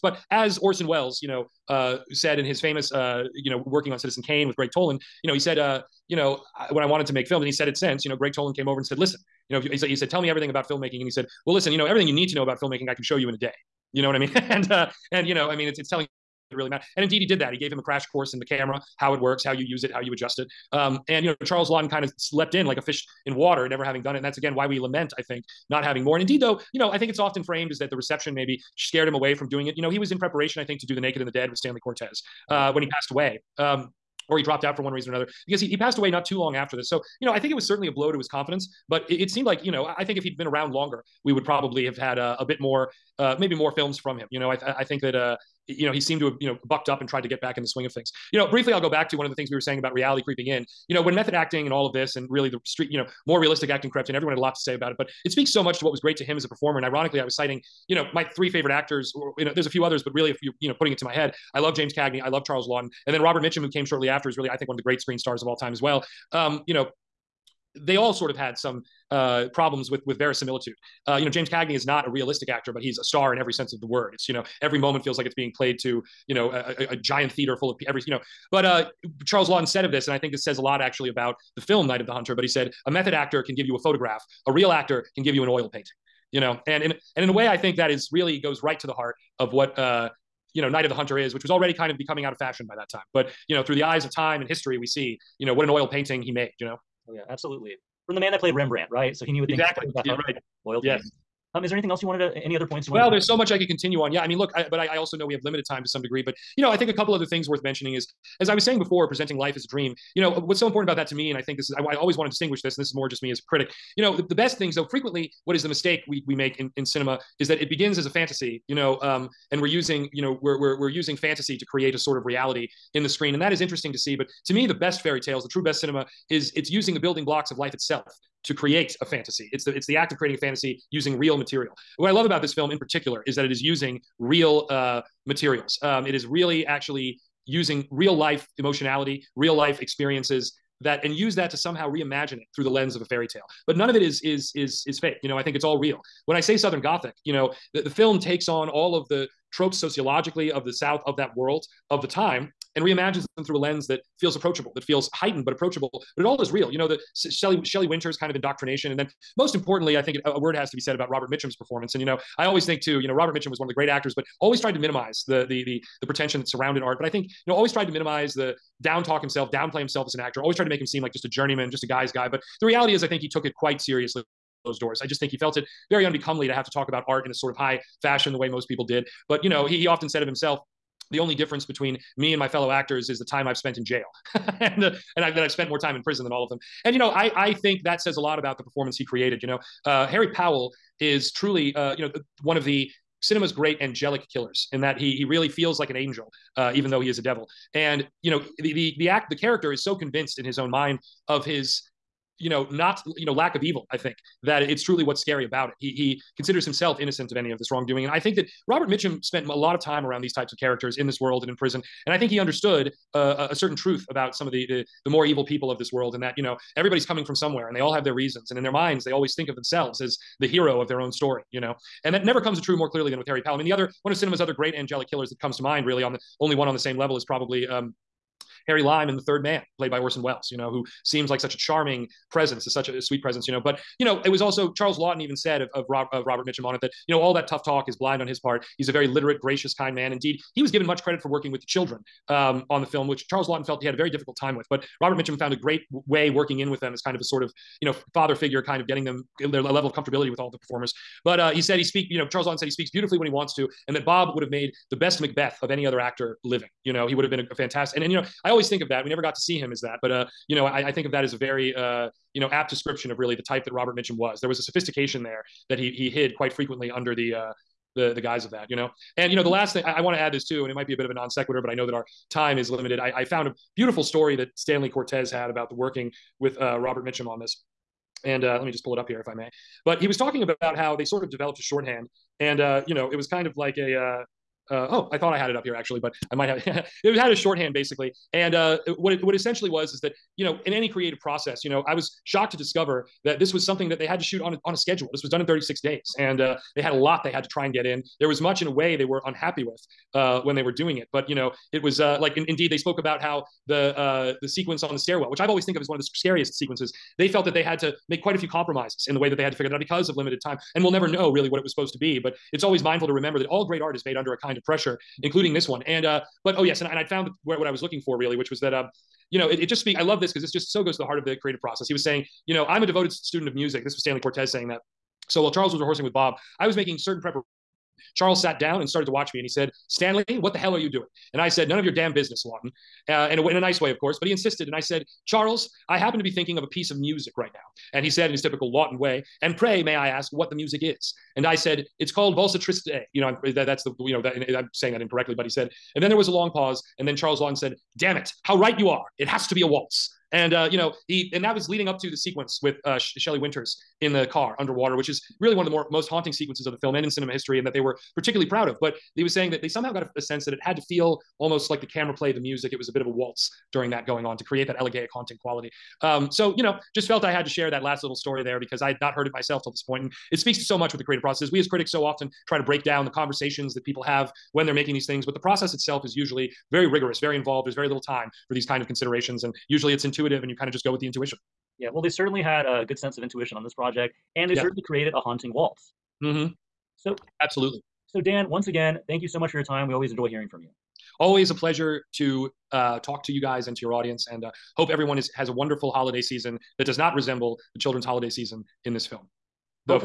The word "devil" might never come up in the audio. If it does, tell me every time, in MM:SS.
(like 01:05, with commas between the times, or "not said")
03:17.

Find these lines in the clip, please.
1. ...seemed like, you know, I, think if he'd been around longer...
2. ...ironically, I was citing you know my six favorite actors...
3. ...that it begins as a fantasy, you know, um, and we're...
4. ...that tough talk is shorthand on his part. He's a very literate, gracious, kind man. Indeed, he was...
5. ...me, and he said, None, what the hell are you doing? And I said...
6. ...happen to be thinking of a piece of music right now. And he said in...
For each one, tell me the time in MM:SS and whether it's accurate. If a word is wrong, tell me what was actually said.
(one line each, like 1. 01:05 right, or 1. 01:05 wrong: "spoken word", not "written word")
1. 00:39 right
2. 00:56 wrong: "three", not "six"
3. 01:57 right
4. 03:57 wrong: "blind", not "shorthand"
5. 05:29 wrong: "Stanley", not "None"
6. 05:35 right.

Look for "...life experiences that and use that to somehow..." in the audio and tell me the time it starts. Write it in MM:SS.
02:19.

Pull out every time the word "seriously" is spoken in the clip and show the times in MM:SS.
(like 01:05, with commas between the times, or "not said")
02:53.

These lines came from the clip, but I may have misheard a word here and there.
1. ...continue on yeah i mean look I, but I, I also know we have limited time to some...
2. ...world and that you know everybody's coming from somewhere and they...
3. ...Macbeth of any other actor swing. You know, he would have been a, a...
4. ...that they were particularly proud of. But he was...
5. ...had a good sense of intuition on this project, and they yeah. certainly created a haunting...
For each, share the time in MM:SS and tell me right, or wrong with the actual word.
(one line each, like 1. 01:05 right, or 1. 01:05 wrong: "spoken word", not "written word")
1. 01:43 right
2. 03:35 right
3. 04:15 wrong: "living", not "swing"
4. 05:57 right
5. 06:22 right.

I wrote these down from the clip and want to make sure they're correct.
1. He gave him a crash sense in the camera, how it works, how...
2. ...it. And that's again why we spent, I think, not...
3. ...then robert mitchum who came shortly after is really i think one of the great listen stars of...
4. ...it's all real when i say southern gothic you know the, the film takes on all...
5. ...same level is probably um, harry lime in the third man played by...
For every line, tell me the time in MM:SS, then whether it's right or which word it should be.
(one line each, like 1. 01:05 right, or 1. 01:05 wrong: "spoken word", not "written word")
1. 00:17 wrong: "course", not "sense"
2. 00:24 wrong: "lament", not "spent"
3. 01:03 wrong: "screen", not "listen"
4. 02:25 right
5. 03:46 right.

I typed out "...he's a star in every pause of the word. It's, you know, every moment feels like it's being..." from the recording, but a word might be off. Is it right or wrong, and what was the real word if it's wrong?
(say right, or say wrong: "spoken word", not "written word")
wrong: "sense", not "pause".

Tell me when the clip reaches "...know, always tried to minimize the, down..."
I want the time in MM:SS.
02:47.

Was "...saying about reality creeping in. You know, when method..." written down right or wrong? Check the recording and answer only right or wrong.
right.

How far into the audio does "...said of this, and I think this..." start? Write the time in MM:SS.
01:19.